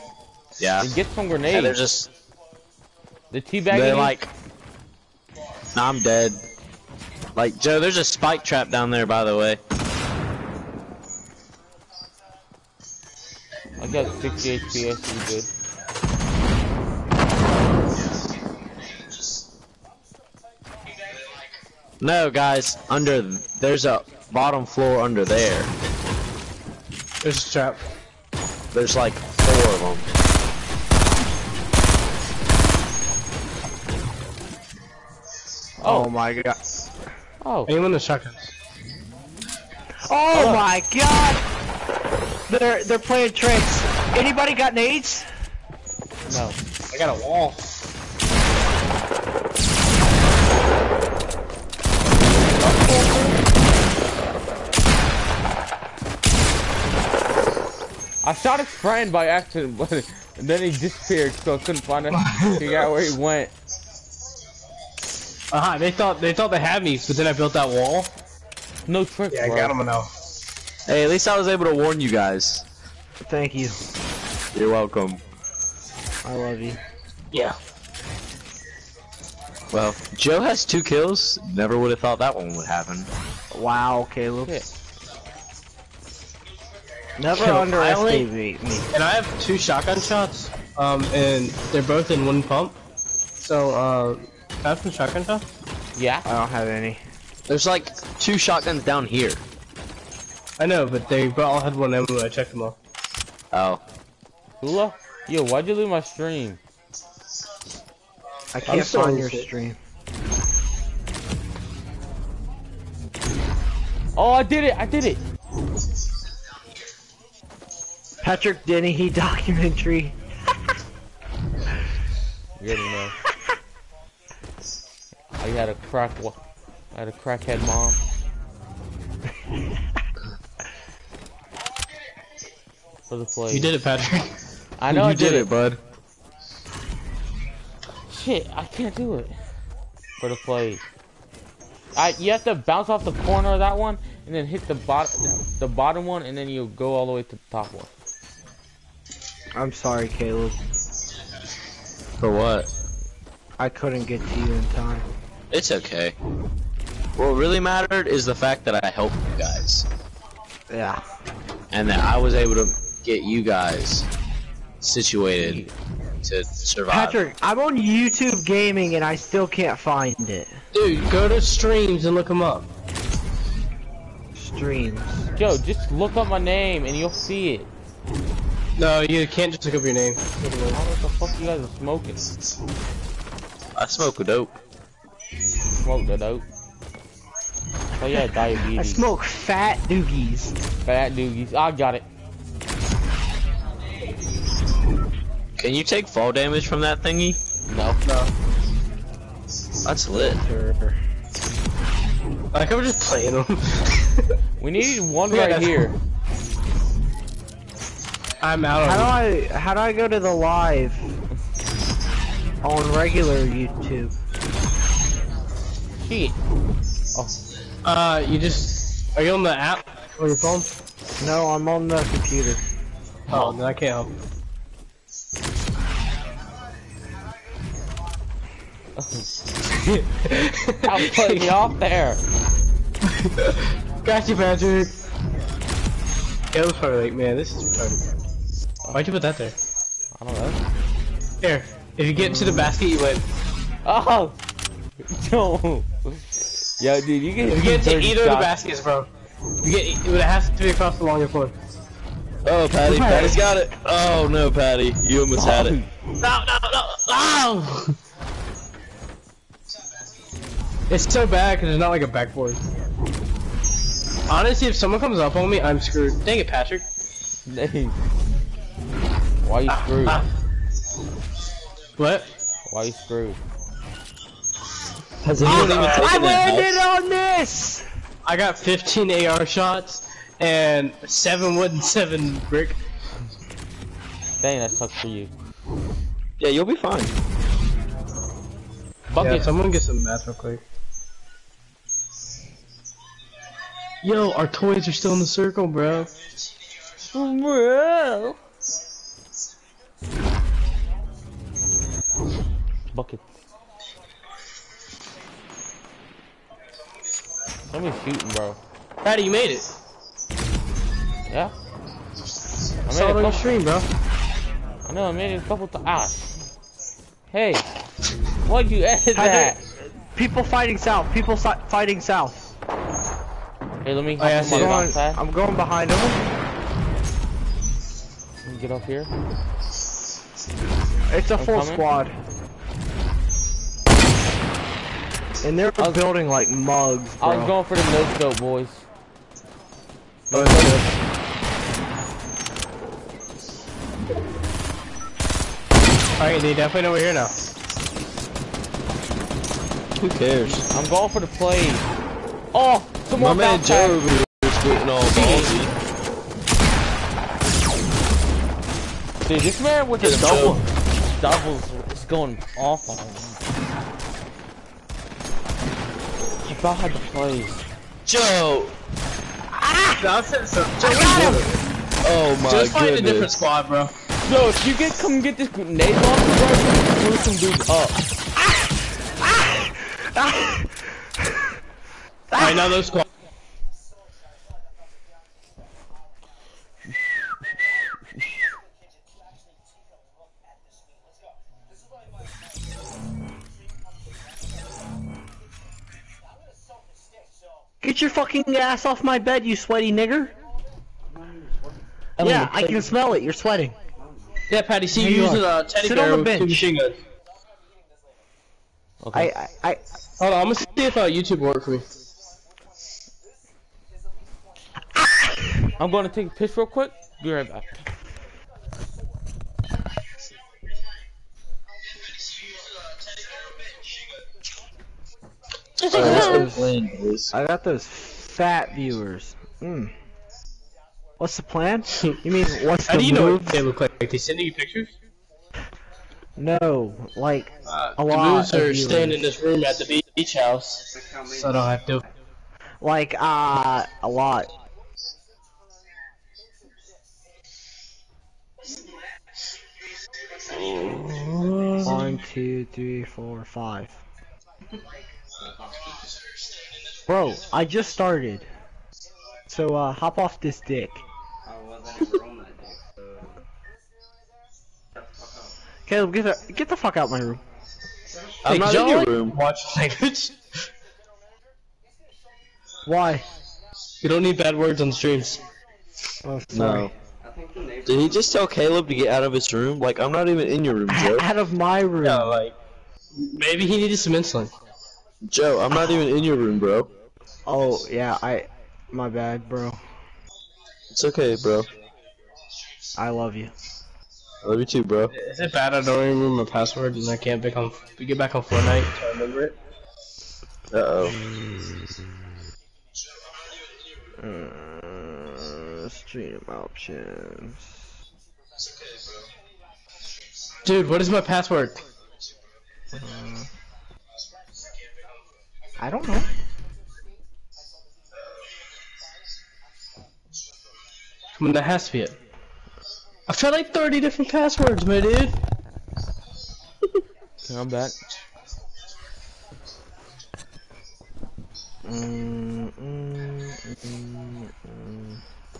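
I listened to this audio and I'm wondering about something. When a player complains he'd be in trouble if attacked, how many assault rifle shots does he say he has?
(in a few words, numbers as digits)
15.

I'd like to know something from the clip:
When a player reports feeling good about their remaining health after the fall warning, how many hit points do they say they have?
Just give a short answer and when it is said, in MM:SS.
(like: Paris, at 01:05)
60, at 00:14.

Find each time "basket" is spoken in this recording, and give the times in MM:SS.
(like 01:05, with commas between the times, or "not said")
04:02, 04:08.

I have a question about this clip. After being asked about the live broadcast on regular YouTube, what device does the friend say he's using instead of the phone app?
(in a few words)
computer.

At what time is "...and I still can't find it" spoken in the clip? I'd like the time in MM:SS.
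02:48.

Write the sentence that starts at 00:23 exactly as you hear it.
There's a bottom floor under there.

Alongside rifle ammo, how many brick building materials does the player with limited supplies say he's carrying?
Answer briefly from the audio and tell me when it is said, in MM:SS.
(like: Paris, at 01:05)
7, at 04:41.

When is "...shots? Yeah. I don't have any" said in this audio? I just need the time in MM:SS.
01:35.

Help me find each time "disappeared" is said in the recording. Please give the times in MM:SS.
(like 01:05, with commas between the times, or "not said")
01:00.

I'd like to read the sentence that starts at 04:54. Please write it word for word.
Yo, our toys are still in the circle, bro.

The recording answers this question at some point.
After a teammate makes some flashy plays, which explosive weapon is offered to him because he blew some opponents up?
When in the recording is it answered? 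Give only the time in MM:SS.
06:15.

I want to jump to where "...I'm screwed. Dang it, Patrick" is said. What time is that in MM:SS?
04:25.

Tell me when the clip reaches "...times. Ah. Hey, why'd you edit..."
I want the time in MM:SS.
05:15.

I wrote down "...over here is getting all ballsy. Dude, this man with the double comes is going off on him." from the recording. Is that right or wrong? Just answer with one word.
wrong.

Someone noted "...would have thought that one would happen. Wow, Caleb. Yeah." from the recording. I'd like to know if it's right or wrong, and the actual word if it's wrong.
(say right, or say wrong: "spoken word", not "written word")
right.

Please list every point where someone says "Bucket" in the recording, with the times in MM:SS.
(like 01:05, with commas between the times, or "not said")
04:49, 05:02.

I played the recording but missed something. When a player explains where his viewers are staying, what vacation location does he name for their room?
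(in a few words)
the beach house.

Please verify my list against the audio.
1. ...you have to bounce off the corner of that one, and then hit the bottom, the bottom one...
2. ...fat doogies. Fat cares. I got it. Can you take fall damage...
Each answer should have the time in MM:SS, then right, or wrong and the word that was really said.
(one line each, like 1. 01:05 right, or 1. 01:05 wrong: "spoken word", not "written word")
1. 02:22 right
2. 03:09 wrong: "doogies", not "cares".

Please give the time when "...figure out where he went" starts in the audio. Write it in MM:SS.
01:02.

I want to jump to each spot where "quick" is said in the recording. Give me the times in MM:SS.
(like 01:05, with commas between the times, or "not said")
04:50, 06:56.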